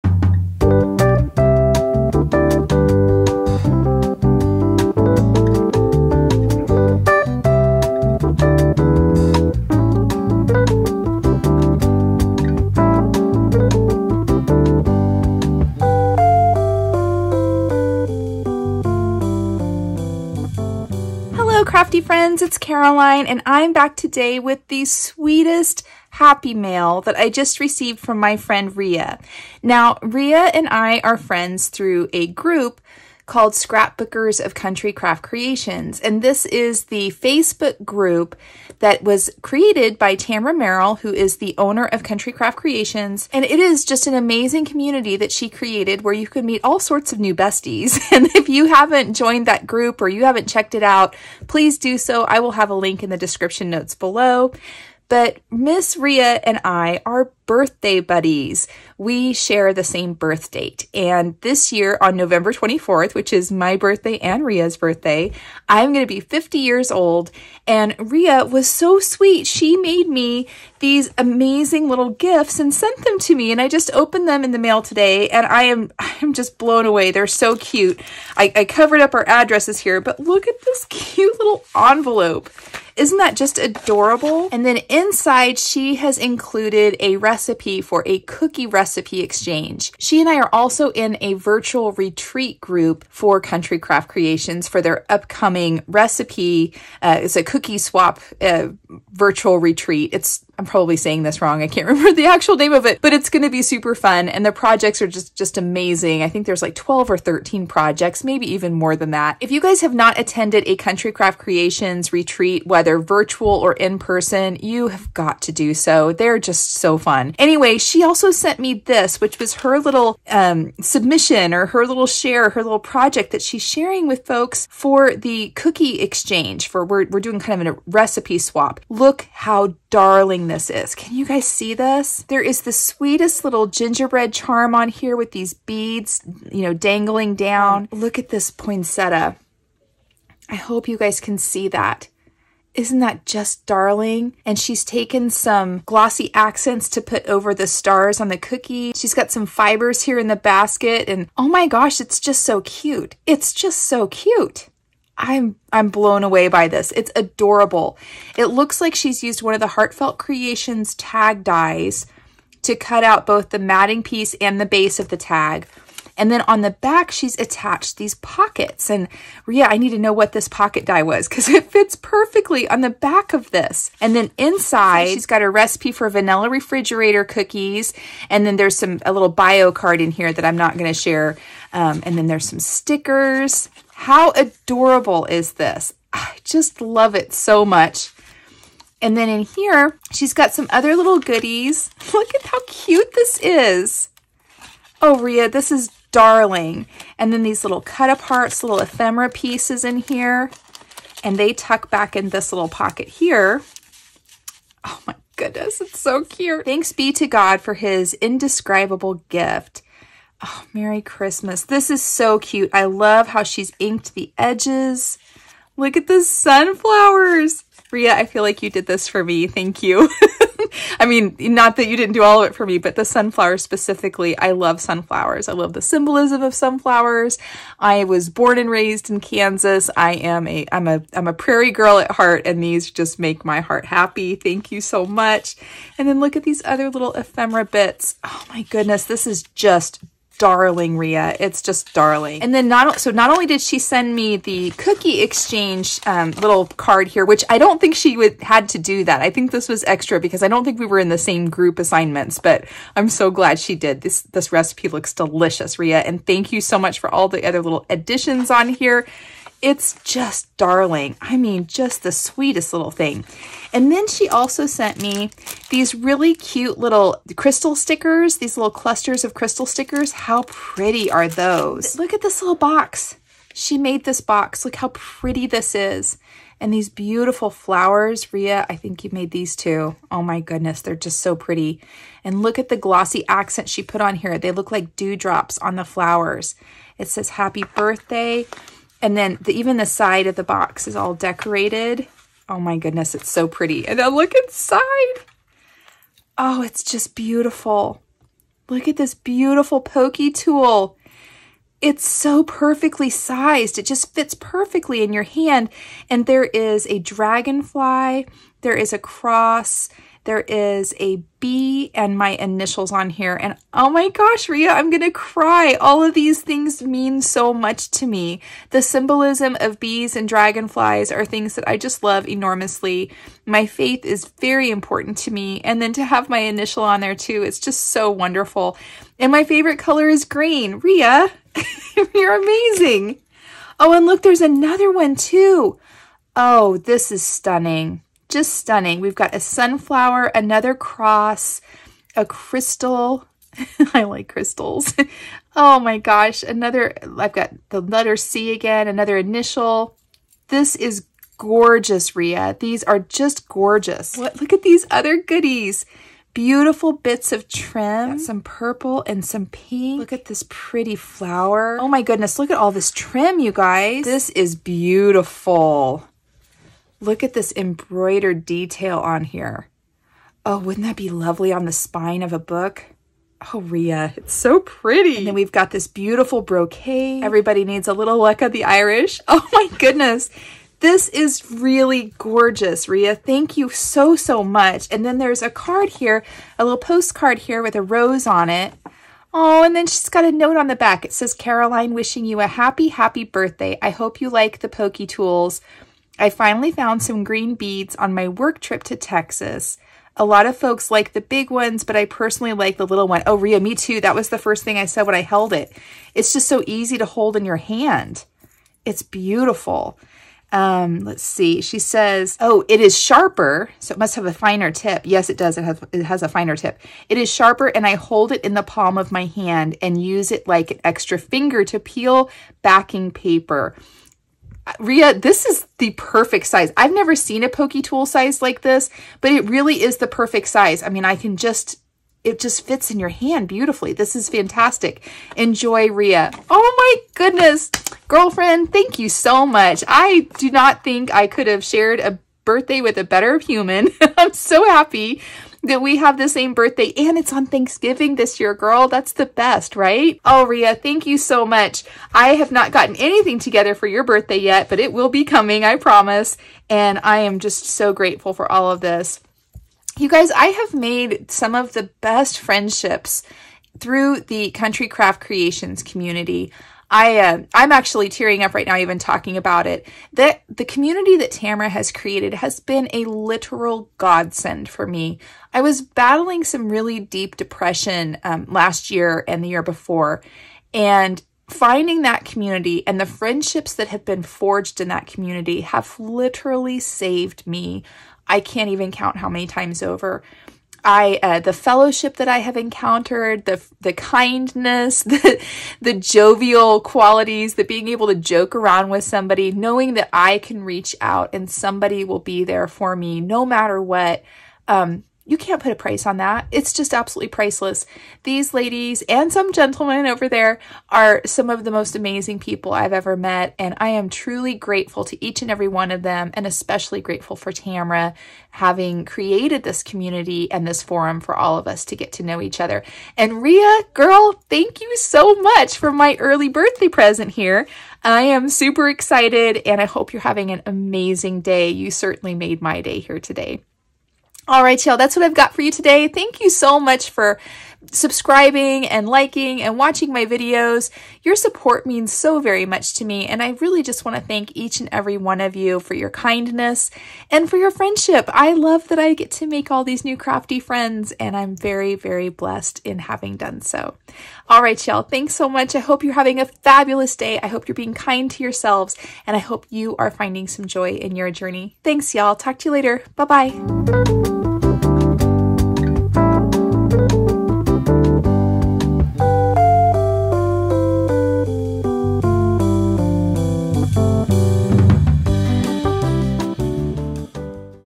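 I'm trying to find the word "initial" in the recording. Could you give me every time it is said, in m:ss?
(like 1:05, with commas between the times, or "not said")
5:12, 5:26, 5:49.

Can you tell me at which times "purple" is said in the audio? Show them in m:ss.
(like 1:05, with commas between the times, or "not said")
5:58.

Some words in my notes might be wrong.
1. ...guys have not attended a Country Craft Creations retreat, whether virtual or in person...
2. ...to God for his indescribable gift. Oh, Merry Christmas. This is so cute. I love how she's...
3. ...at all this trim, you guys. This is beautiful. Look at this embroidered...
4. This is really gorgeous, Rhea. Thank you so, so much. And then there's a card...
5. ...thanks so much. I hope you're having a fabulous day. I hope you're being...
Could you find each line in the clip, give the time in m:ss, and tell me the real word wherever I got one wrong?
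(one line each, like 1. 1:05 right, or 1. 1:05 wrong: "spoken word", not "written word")
1. 1:49 right
2. 3:27 right
3. 6:02 right
4. 6:20 right
5. 9:15 right.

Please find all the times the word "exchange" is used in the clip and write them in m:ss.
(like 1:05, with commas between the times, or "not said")
1:29, 2:06, 4:05.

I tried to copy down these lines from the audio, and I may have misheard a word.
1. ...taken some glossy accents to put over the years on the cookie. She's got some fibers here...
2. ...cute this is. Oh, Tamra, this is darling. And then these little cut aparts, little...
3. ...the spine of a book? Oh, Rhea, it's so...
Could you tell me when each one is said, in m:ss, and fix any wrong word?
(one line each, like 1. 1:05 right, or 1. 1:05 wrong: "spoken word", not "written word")
1. 2:24 wrong: "stars", not "years"
2. 3:12 wrong: "Rhea", not "Tamra"
3. 6:11 right.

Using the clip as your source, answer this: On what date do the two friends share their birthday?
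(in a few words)
November 24th.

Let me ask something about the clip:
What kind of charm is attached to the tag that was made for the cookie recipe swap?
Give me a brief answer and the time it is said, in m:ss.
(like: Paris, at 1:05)
gingerbread, at 2:13.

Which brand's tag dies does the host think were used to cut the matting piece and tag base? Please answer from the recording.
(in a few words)
Heartfelt Creations.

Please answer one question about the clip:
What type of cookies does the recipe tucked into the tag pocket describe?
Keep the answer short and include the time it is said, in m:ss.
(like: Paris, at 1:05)
vanilla refrigerator cookies, at 2:56.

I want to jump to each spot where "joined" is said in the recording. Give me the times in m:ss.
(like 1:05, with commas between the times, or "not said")
0:49.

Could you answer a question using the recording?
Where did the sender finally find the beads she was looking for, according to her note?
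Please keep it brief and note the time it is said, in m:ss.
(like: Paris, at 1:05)
Texas, at 6:38.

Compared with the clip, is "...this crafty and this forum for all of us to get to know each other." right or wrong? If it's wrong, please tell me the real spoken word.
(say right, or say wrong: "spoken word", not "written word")
wrong: "community", not "crafty".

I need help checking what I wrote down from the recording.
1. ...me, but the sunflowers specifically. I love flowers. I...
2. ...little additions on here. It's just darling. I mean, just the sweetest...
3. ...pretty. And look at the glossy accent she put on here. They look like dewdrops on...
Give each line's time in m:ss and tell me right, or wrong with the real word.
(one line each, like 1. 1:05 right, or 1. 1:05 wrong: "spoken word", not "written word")
1. 3:42 wrong: "sunflowers", not "flowers"
2. 4:17 right
3. 4:41 right.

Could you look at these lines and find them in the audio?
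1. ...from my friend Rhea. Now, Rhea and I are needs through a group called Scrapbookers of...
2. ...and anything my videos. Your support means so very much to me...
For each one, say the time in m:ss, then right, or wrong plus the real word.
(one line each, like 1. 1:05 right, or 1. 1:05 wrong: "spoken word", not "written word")
1. 0:27 wrong: "friends", not "needs"
2. 8:59 wrong: "watching", not "anything".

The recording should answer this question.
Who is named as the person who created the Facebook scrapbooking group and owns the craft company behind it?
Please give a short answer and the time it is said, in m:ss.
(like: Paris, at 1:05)
Tamra Merrill, at 0:40.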